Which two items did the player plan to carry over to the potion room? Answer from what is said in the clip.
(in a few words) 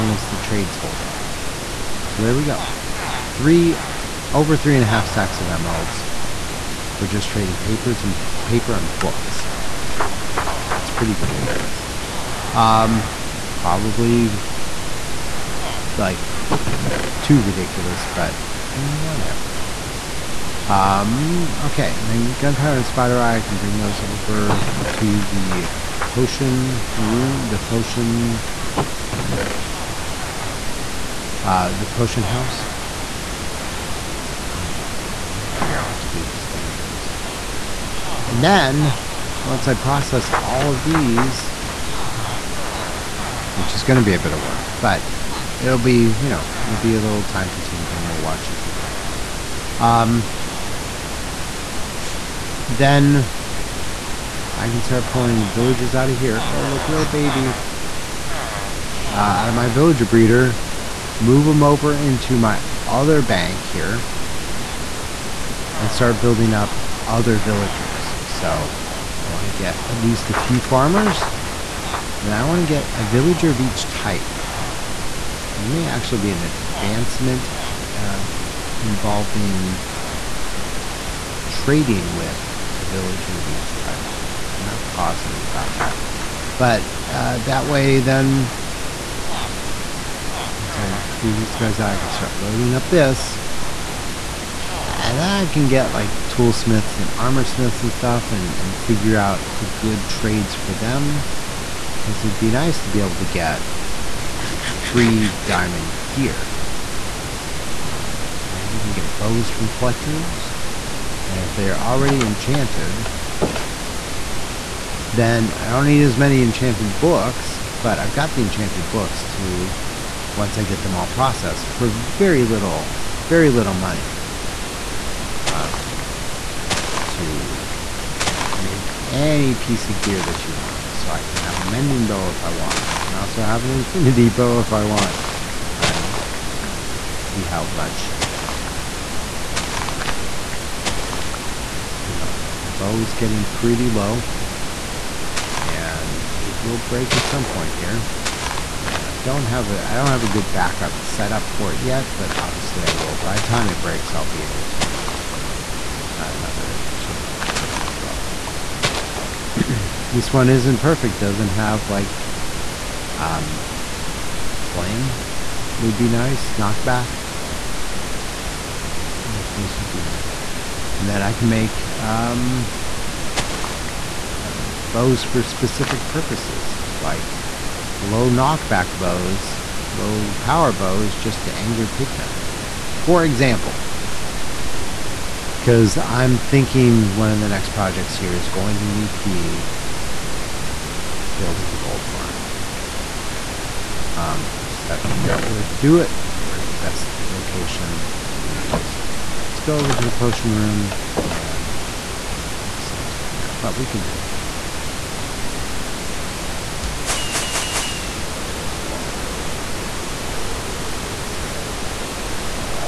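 Gunpowder and Spider Eye.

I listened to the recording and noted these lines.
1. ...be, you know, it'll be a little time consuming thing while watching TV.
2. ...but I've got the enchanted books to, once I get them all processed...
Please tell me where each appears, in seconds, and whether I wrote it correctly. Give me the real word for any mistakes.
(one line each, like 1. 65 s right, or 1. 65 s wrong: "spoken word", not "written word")
1. 45 s right
2. 117 s right.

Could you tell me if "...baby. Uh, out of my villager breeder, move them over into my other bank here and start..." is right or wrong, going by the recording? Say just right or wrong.
right.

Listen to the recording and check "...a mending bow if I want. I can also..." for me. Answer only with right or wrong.
right.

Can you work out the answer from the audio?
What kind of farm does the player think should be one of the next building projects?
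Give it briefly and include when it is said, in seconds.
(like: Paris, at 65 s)
gold farm, at 191 s.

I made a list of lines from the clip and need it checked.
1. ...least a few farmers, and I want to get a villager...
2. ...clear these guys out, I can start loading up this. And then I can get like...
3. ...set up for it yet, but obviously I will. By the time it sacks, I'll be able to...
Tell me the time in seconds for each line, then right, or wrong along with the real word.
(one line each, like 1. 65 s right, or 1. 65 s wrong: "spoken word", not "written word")
1. 69 s right
2. 91 s right
3. 151 s wrong: "breaks", not "sacks".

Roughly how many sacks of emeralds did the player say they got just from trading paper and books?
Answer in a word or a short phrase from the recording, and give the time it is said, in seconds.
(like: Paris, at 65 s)
3.5, at 4 s.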